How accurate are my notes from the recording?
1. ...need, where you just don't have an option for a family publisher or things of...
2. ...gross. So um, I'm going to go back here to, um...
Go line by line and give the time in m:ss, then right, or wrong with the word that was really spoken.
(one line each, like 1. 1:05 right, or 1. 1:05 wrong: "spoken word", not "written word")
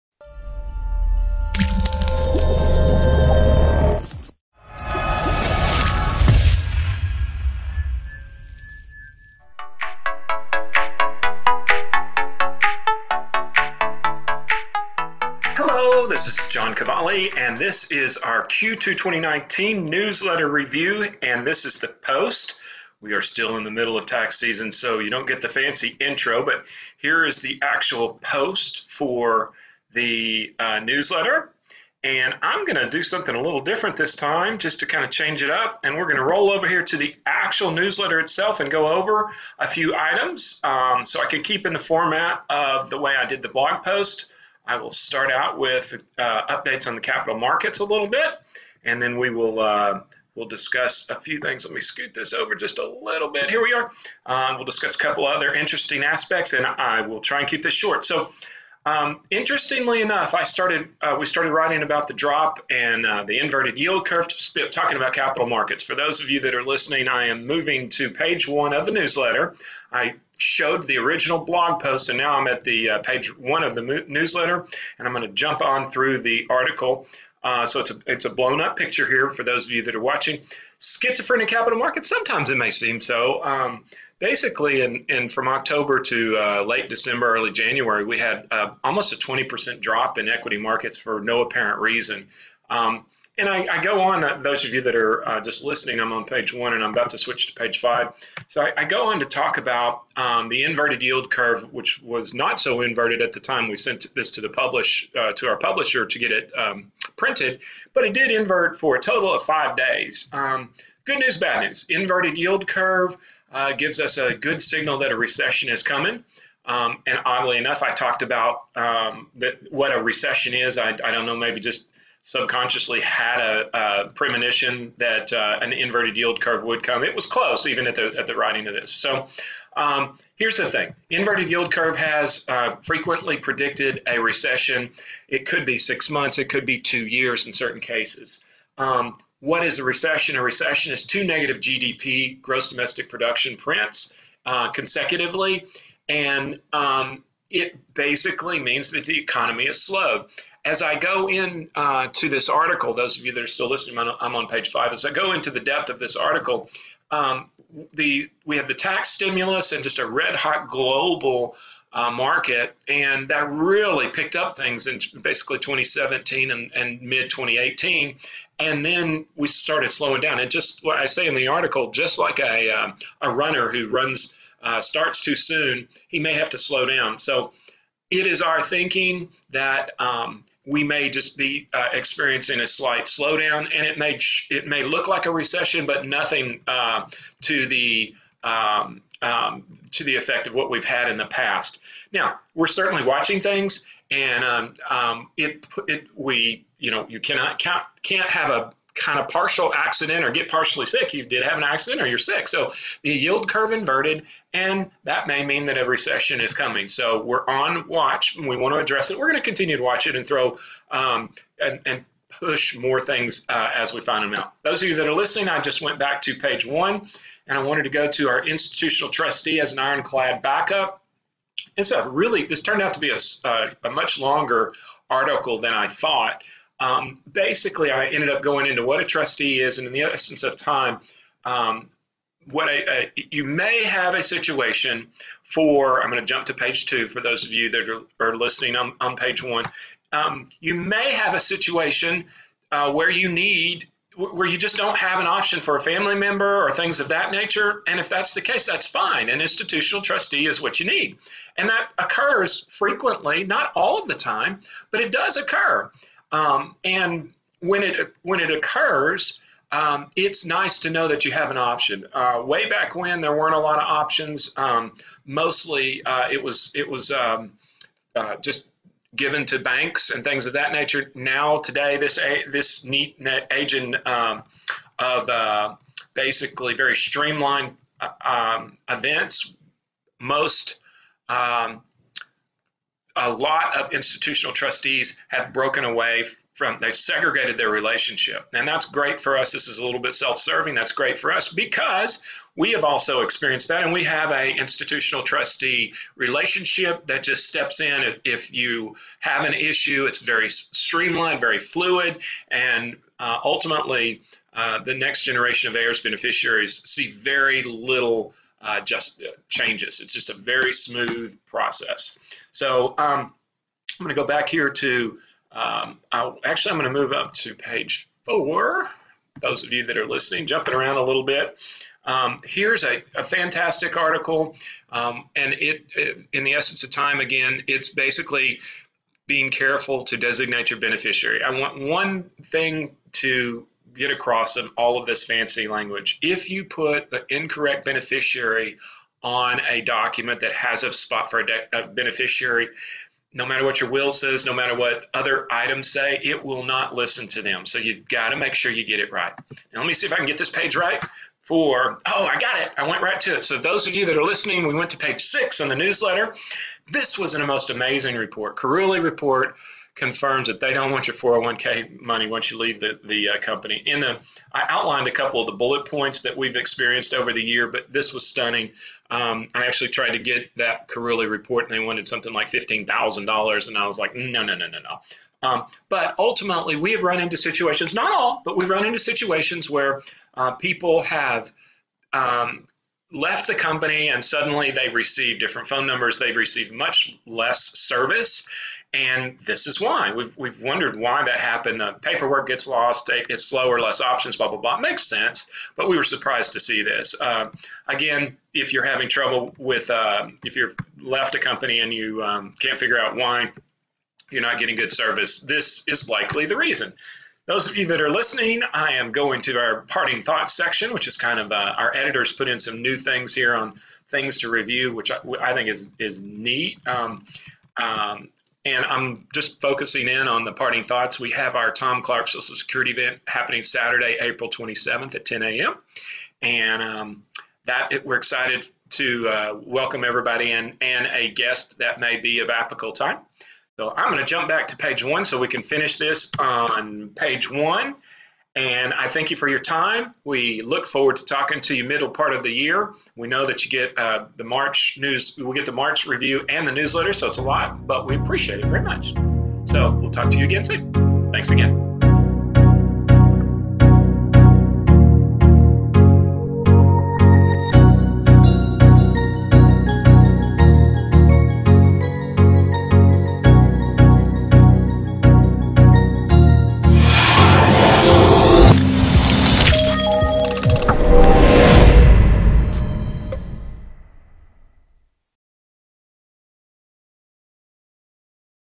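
1. 4:03 wrong: "member", not "publisher"
2. 5:11 wrong: "process", not "gross".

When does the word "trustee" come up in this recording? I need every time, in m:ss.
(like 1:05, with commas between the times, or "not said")
3:39, 3:49, 4:10, 4:44, 4:55.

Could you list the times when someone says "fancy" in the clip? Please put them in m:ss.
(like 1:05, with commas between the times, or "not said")
0:25, 5:35.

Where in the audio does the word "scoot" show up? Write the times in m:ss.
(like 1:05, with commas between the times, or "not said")
0:51.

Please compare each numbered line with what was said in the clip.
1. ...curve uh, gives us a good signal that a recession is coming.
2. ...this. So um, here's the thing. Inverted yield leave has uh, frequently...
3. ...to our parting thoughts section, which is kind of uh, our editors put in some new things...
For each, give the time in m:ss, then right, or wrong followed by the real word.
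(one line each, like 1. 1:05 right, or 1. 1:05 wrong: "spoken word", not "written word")
1. 1:52 right
2. 2:08 wrong: "curve", not "leave"
3. 6:49 right.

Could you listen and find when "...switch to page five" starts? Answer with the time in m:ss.
1:37.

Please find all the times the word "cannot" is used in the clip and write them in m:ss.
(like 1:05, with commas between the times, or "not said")
3:17.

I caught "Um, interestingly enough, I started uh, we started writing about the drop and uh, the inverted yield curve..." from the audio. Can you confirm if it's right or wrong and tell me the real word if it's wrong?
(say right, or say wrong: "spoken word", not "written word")
right.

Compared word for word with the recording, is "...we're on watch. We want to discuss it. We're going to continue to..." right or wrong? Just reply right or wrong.
wrong.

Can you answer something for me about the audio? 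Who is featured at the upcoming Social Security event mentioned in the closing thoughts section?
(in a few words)
Tom Clark.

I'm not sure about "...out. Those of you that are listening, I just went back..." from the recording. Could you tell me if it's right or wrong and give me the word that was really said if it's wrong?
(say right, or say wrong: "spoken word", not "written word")
right.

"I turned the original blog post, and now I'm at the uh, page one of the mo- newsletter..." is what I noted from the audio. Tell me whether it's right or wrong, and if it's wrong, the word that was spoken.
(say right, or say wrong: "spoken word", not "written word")
wrong: "showed", not "turned".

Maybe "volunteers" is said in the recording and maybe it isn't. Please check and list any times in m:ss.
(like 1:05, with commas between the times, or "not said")
not said.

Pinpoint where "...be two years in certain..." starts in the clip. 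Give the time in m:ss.
2:16.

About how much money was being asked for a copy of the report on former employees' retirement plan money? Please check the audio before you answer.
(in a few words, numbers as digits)
$15,000.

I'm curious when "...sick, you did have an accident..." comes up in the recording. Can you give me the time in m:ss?
3:20.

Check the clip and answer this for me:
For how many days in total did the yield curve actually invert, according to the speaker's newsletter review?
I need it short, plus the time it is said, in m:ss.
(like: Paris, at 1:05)
5, at 1:49.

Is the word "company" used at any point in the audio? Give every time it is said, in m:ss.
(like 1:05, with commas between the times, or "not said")
6:03, 6:23, 6:41.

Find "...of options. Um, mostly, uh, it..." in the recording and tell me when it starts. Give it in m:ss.
4:23.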